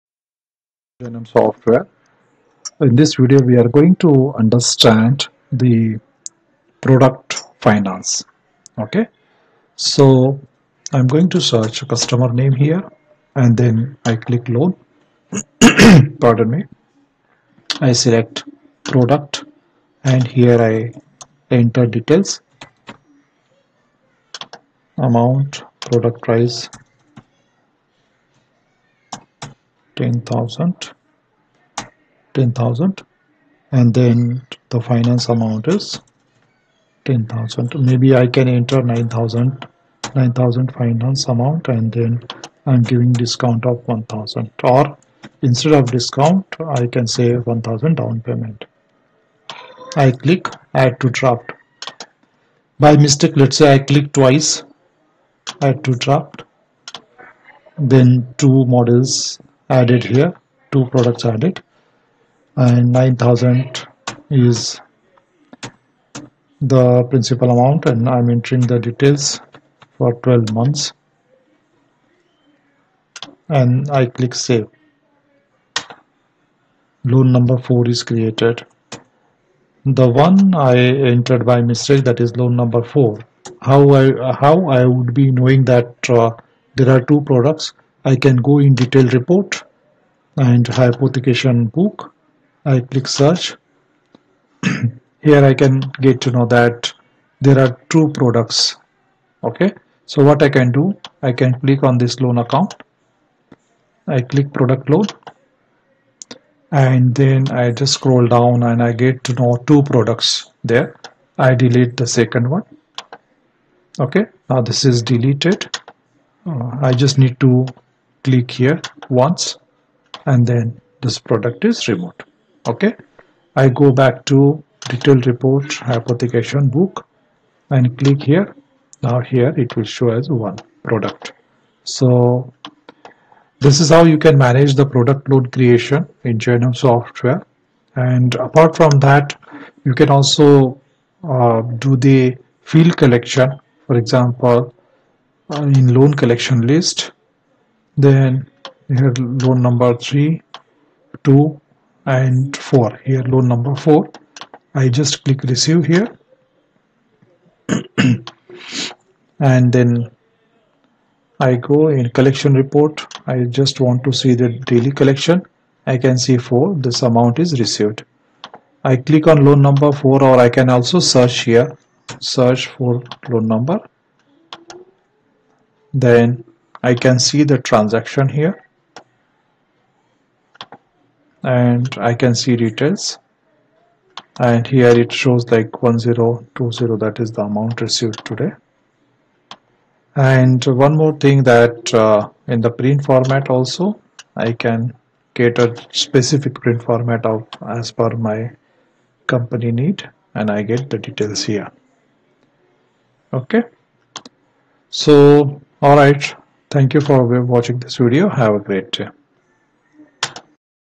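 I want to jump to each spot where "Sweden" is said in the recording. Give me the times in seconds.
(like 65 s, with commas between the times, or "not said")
not said.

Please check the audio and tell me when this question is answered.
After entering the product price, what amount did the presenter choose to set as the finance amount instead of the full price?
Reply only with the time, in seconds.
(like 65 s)
37 s.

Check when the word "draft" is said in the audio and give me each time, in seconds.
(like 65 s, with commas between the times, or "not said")
51 s, 56 s.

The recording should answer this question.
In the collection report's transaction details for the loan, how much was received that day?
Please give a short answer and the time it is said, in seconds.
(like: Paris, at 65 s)
1020, at 185 s.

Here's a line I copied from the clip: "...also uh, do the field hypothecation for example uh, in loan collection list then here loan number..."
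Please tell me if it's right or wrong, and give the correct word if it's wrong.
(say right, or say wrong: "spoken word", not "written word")
wrong: "collection", not "hypothecation".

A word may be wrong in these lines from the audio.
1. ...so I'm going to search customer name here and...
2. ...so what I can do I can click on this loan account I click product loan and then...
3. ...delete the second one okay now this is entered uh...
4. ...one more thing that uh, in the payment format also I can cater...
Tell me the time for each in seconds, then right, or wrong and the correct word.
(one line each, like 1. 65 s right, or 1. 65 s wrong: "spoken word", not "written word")
1. 9 s right
2. 100 s right
3. 111 s wrong: "deleted", not "entered"
4. 190 s wrong: "print", not "payment".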